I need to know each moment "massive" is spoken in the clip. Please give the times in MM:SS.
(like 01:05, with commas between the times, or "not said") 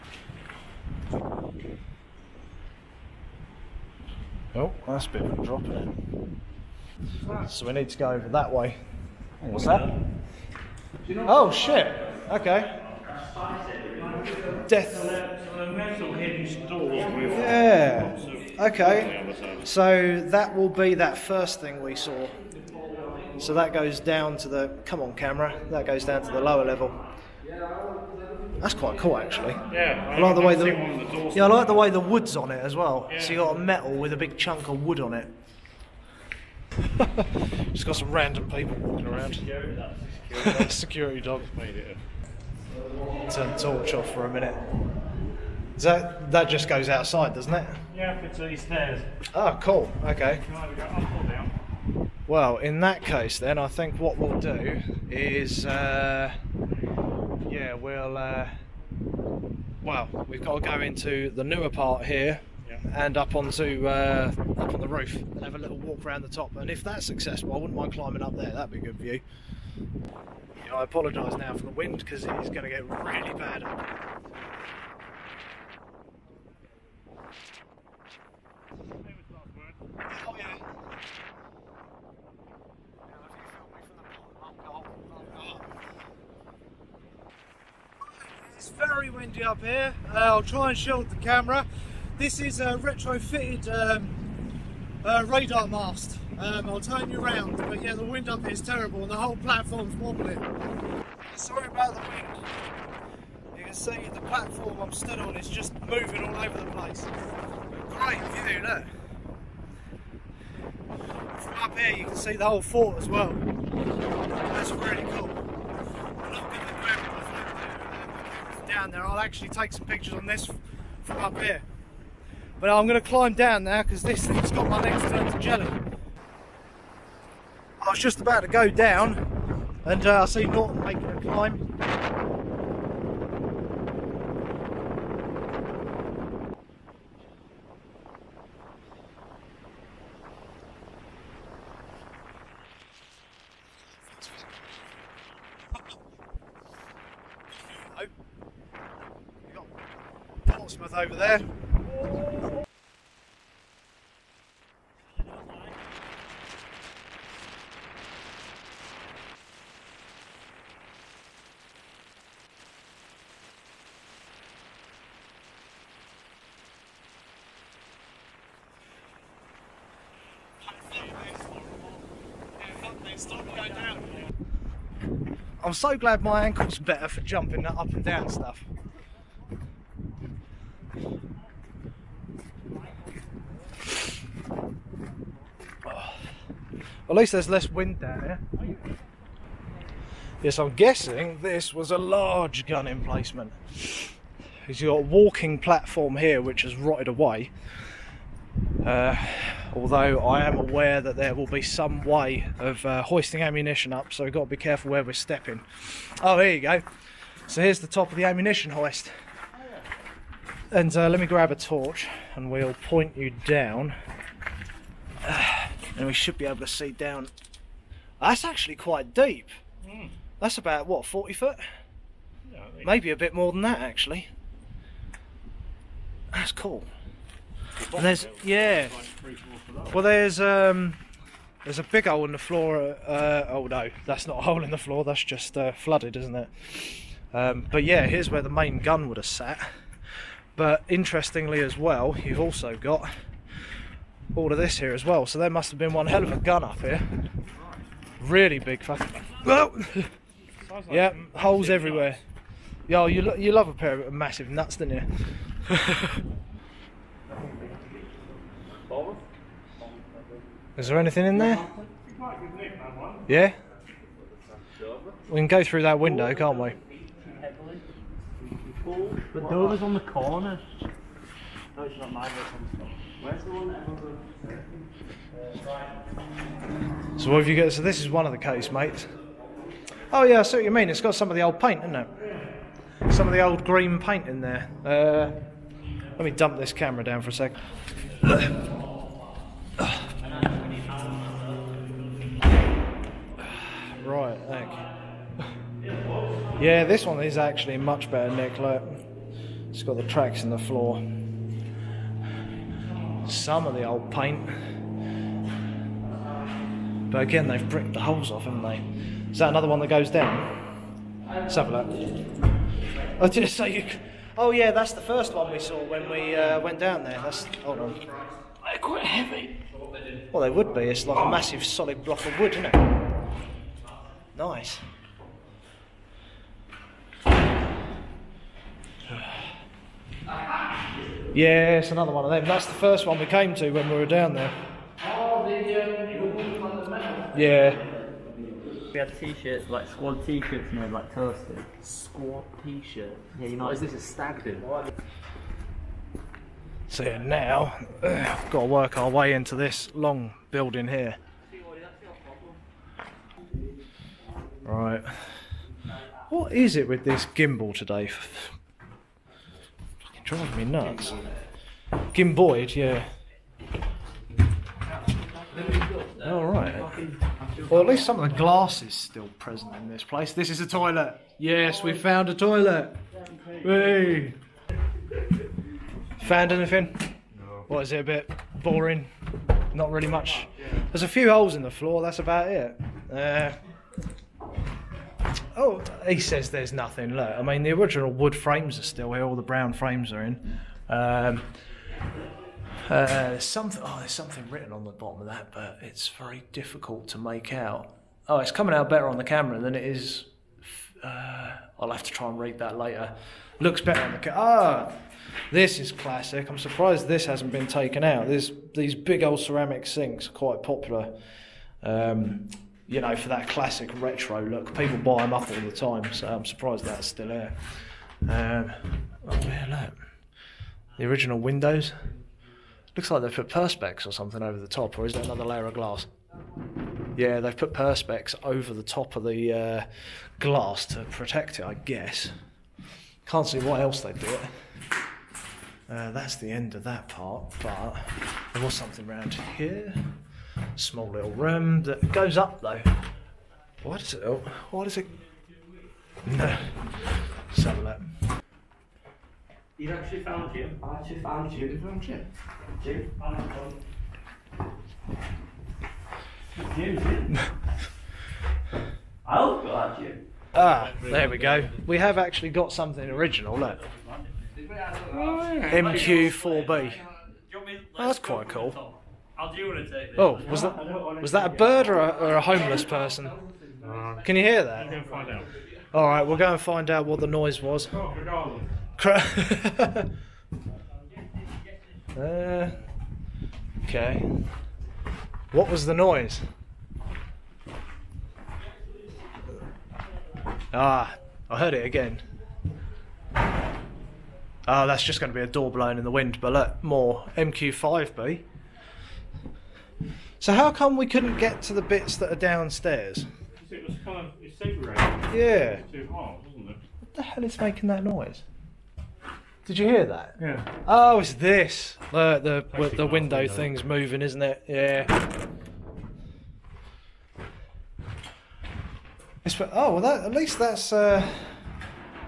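04:14, 05:21.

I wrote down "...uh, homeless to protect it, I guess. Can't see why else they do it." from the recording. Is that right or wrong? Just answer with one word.
wrong.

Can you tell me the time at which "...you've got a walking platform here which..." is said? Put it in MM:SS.
03:14.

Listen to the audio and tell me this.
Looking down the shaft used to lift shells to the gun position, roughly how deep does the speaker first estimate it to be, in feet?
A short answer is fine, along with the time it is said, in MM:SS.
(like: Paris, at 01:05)
40, at 03:41.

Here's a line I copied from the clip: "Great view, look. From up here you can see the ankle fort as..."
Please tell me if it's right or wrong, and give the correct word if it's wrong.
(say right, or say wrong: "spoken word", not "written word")
wrong: "whole", not "ankle".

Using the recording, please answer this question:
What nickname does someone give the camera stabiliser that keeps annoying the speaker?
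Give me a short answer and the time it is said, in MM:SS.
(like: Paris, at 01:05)
Gimboid, at 06:02.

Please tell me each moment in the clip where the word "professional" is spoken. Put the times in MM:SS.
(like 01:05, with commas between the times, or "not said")
not said.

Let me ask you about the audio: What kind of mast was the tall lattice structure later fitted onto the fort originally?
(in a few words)
Radar mast.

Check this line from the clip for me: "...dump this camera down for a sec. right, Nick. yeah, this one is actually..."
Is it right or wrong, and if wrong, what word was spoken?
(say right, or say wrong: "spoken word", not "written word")
right.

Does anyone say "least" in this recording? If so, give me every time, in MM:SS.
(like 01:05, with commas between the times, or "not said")
03:07, 06:07, 08:40.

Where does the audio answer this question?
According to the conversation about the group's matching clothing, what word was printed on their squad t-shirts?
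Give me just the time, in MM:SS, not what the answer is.
05:41.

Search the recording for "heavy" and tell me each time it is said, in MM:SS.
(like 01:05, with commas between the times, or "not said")
05:19.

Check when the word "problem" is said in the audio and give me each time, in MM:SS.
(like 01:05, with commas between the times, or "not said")
not said.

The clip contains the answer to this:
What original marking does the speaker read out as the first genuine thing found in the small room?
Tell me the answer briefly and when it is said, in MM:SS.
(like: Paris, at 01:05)
MQ4B, at 07:44.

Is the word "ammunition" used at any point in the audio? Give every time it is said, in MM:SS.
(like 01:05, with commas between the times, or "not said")
03:23, 03:28.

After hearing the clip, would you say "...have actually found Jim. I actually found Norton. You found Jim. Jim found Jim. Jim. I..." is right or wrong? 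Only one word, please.
wrong.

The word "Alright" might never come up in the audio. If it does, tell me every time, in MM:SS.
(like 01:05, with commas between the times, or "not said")
06:06.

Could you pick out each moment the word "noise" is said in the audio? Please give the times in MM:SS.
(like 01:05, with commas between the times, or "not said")
07:57, 08:05, 08:28.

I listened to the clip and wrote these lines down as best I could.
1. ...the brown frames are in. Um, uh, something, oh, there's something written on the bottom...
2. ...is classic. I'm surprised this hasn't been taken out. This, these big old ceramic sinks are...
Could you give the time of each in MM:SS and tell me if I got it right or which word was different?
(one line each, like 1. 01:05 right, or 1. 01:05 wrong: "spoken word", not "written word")
1. 06:29 right
2. 06:45 right.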